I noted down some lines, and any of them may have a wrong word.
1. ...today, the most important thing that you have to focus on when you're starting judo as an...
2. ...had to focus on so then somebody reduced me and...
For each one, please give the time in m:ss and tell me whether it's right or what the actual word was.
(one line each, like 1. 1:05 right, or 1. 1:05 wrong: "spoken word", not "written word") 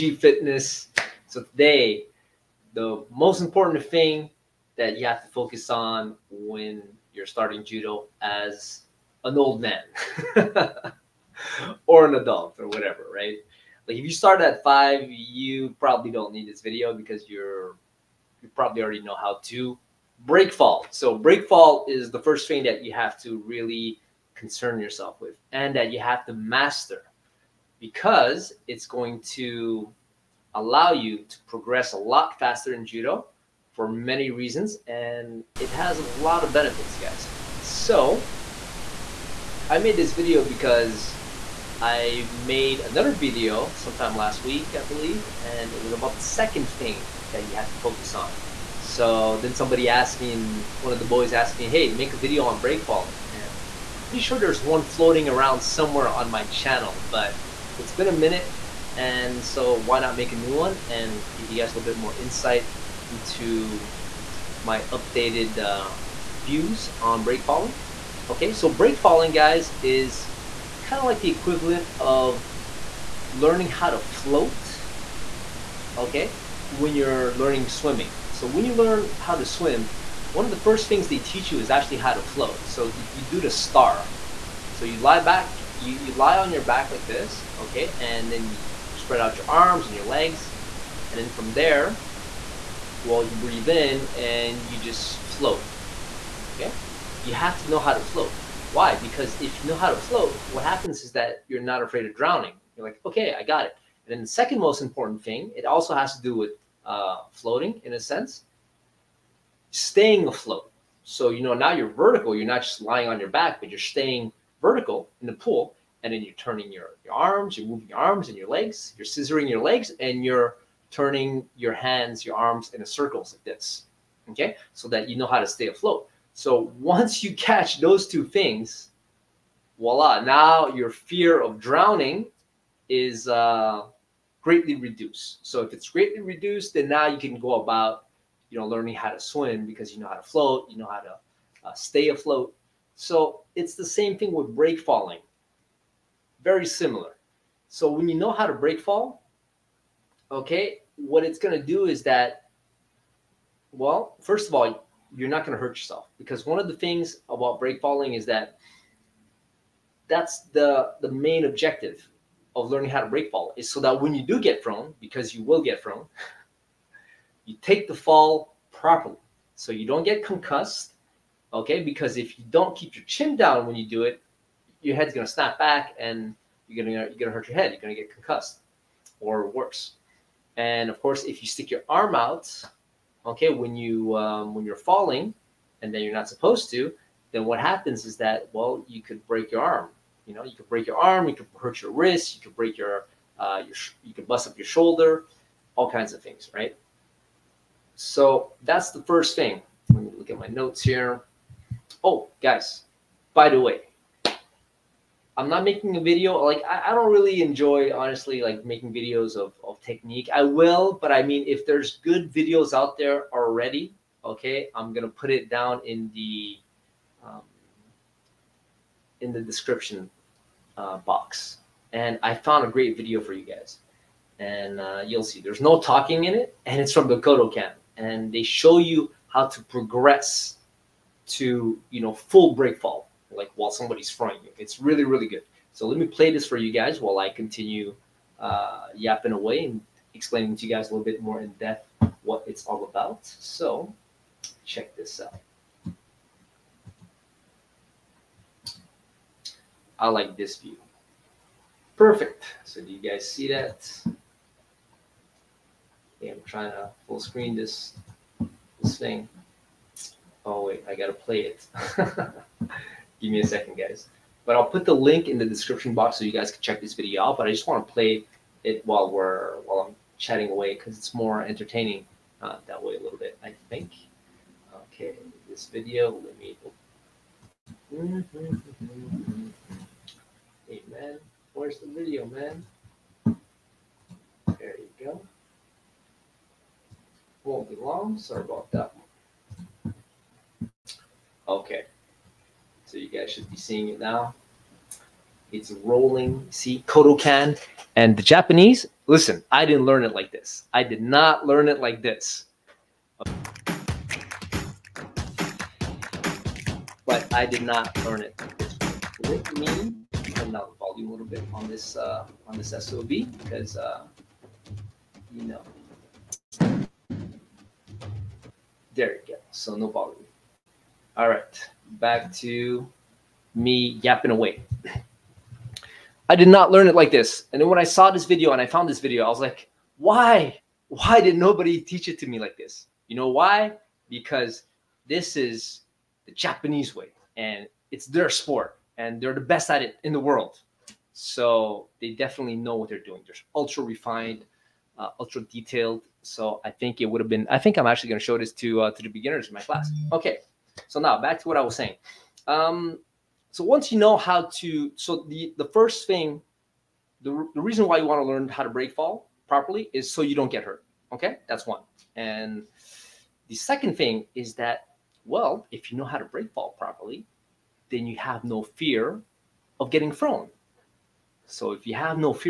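1. 0:01 right
2. 0:47 wrong: "asked", not "reduced".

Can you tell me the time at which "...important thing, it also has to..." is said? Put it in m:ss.
1:44.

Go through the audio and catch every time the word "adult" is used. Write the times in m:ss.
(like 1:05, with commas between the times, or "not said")
0:12.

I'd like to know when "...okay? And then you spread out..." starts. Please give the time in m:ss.
1:27.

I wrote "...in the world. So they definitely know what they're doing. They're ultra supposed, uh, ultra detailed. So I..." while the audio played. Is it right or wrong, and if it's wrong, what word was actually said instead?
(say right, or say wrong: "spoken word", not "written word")
wrong: "refined", not "supposed".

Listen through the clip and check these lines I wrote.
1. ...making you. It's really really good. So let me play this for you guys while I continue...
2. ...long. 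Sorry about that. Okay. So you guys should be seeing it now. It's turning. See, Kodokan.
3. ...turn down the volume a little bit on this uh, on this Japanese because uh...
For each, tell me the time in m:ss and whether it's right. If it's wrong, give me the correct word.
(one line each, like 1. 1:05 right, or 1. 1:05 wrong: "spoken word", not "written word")
1. 3:54 wrong: "frying", not "making"
2. 4:47 wrong: "rolling", not "turning"
3. 5:10 wrong: "SOB", not "Japanese".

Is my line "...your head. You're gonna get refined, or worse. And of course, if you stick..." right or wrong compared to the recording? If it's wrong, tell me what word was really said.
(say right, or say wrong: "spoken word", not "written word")
wrong: "concussed", not "refined".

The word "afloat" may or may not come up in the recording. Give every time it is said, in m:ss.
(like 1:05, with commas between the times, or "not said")
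1:50, 2:05, 2:22.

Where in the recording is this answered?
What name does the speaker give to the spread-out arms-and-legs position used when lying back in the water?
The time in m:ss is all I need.
1:23.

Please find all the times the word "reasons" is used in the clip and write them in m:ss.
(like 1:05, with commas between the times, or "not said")
0:34, 5:57.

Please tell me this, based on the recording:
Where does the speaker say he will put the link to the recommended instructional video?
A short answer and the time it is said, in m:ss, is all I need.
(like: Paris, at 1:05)
Description box, at 4:25.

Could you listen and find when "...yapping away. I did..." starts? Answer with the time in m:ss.
5:24.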